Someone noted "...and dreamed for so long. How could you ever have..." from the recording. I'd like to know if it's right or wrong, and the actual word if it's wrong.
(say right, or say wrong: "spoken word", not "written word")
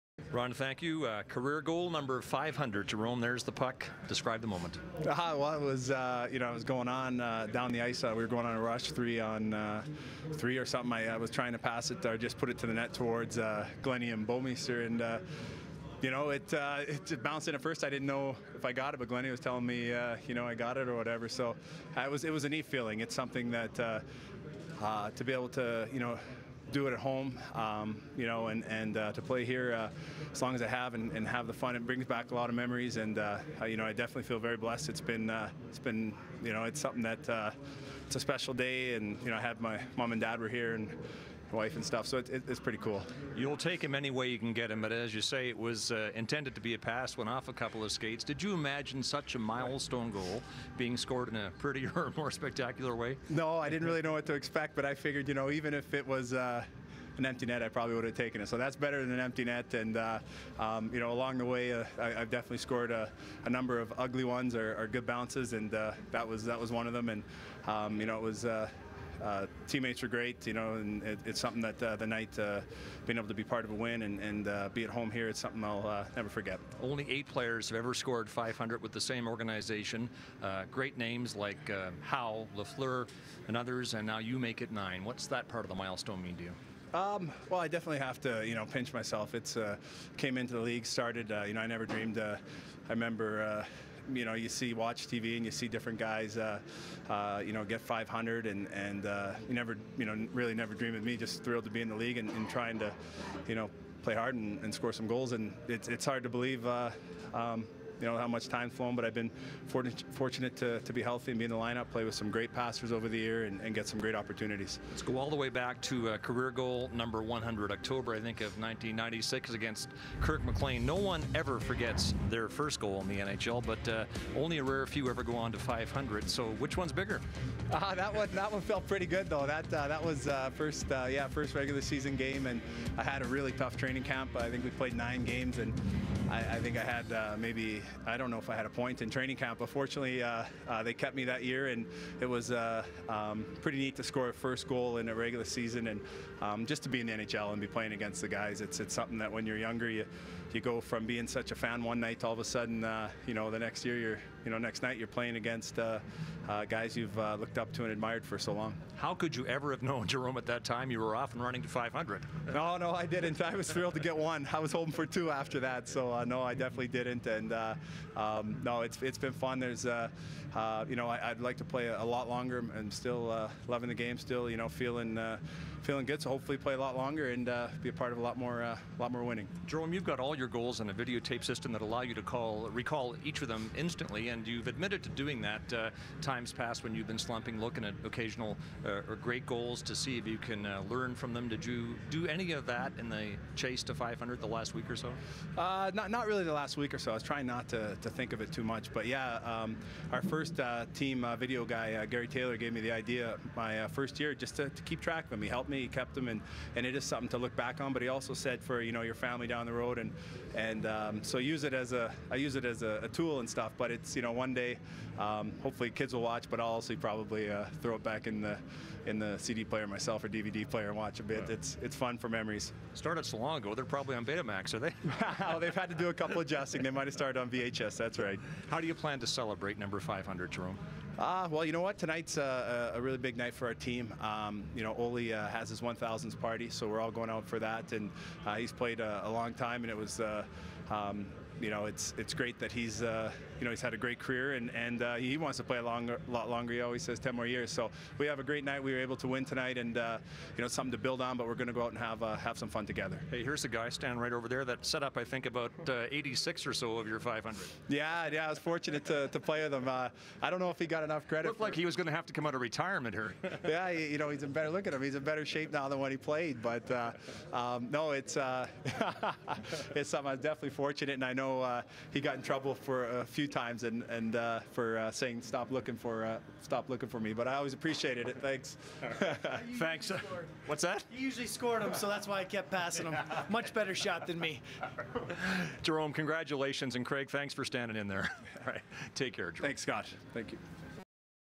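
wrong: "admired", not "dreamed".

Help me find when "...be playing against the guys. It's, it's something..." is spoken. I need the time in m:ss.
2:27.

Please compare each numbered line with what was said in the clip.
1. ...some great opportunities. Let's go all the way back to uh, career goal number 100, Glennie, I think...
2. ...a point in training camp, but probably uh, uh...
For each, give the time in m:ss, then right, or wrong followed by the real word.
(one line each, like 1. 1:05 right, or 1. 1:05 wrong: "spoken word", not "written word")
1. 1:53 wrong: "October", not "Glennie"
2. 2:18 wrong: "fortunately", not "probably".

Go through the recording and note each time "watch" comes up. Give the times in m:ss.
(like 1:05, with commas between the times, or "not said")
1:34, 3:36, 3:40.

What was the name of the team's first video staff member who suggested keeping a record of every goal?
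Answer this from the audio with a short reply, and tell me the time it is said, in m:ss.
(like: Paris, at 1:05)
Gary Taylor, at 3:22.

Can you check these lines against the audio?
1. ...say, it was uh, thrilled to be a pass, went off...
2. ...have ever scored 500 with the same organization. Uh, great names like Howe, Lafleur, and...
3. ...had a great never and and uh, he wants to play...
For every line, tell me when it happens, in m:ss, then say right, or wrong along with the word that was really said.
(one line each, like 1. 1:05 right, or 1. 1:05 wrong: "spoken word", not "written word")
1. 0:45 wrong: "intended", not "thrilled"
2. 1:17 right
3. 4:03 wrong: "career", not "never".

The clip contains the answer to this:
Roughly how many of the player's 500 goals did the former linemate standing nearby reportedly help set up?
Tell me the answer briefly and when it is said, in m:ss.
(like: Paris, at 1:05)
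86, at 4:16.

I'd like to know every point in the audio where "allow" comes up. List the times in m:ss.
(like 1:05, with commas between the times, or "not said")
3:01.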